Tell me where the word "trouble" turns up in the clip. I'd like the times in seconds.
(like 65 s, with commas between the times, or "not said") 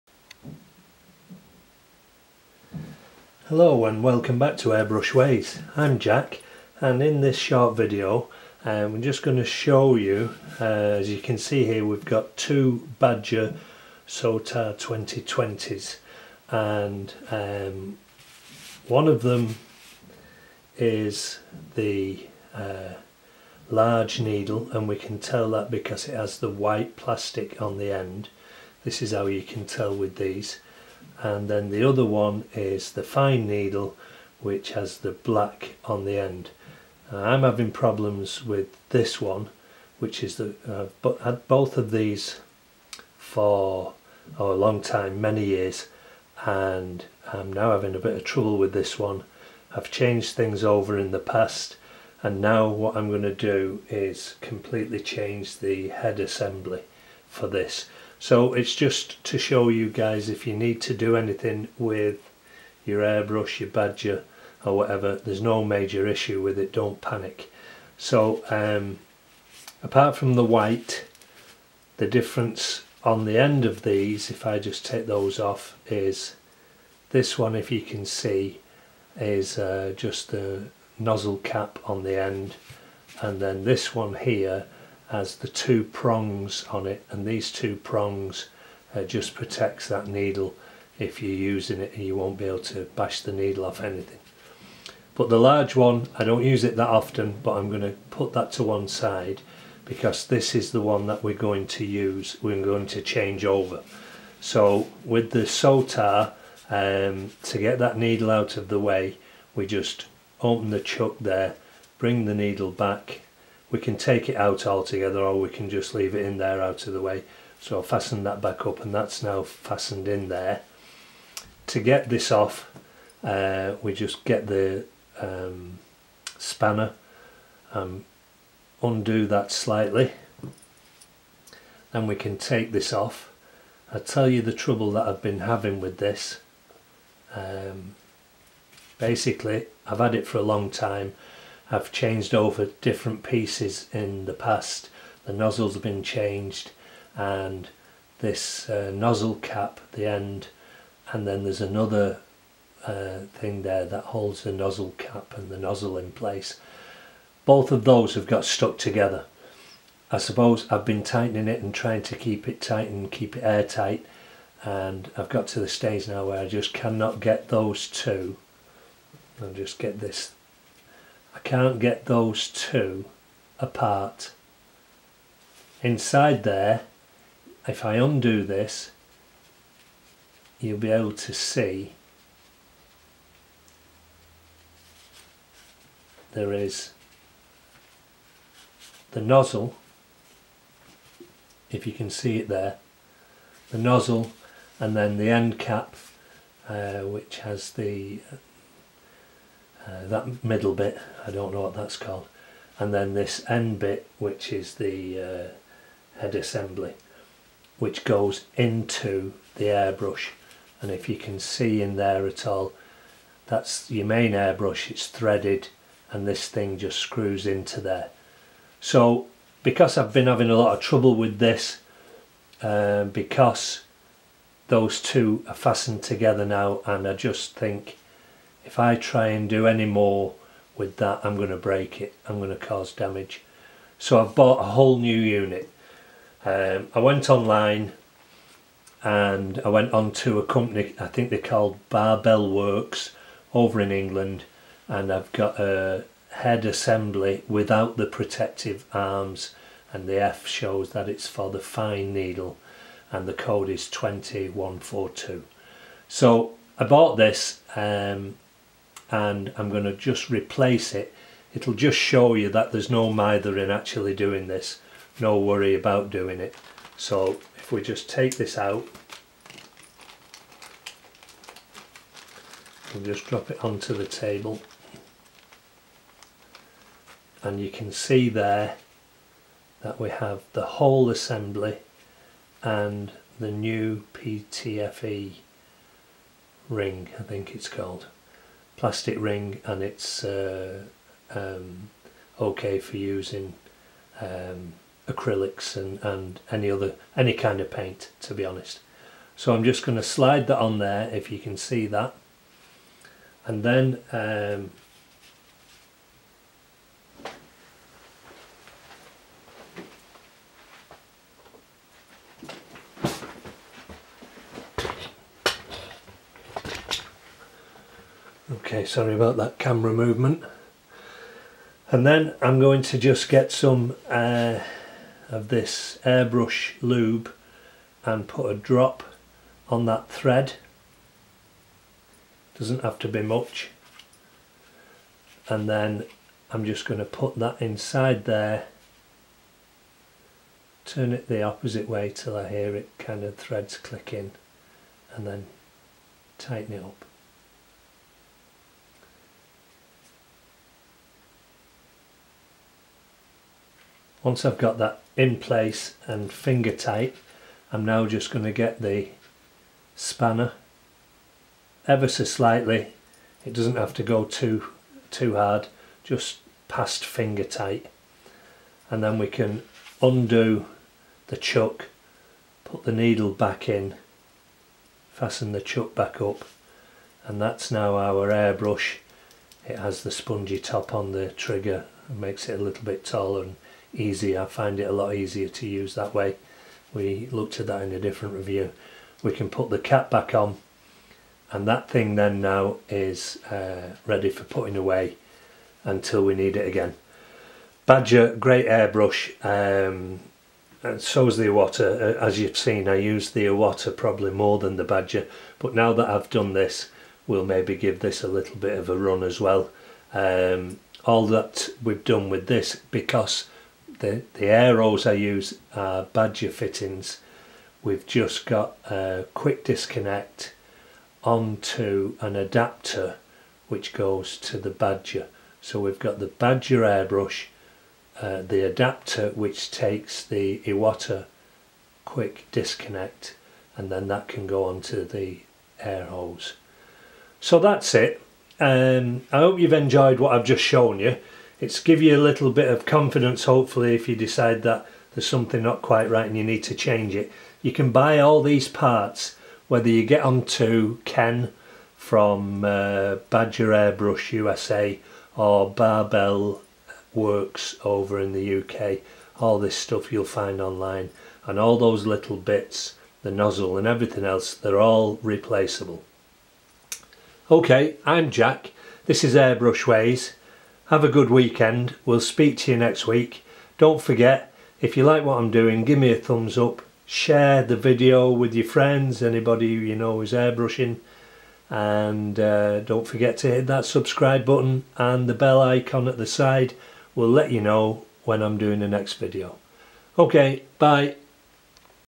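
48 s, 134 s, 220 s.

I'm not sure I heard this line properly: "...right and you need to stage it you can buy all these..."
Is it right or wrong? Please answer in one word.
wrong.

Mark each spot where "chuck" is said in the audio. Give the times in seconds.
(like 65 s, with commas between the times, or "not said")
110 s, 371 s, 375 s.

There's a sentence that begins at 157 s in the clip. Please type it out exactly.
Both of those have got stuck together.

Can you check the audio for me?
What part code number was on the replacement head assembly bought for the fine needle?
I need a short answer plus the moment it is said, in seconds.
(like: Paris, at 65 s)
2142, at 253 s.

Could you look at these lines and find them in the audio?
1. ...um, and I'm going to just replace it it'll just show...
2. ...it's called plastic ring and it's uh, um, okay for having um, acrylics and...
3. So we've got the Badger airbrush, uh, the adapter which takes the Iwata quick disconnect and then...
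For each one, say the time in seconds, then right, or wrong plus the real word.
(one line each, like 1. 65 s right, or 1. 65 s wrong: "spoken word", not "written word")
1. 257 s right
2. 287 s wrong: "using", not "having"
3. 425 s right.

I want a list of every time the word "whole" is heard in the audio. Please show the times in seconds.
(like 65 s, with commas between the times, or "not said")
234 s, 280 s.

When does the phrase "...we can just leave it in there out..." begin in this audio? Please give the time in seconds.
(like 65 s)
115 s.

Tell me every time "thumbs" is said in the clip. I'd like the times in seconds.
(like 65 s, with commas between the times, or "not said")
476 s.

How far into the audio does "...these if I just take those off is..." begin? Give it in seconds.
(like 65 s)
73 s.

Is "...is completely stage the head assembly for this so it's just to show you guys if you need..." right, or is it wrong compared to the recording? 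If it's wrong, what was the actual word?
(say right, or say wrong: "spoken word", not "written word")
wrong: "change", not "stage".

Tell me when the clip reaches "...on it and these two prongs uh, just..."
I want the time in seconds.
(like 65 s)
86 s.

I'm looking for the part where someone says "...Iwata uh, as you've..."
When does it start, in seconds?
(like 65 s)
401 s.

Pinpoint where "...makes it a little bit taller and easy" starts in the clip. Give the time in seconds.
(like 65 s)
382 s.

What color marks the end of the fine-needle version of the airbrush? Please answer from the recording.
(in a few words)
Black.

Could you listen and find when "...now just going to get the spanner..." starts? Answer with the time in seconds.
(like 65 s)
357 s.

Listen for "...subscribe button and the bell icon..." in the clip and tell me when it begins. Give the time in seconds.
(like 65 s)
483 s.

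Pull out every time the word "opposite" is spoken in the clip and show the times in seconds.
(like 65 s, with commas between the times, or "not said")
341 s.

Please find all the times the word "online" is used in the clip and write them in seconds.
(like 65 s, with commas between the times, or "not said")
237 s, 460 s.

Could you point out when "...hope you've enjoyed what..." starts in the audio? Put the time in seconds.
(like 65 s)
439 s.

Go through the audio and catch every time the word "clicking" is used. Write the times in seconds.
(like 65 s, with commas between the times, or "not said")
343 s.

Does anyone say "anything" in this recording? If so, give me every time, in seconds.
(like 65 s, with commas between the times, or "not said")
61 s, 93 s.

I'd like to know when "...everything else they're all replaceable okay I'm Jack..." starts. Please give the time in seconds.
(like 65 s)
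463 s.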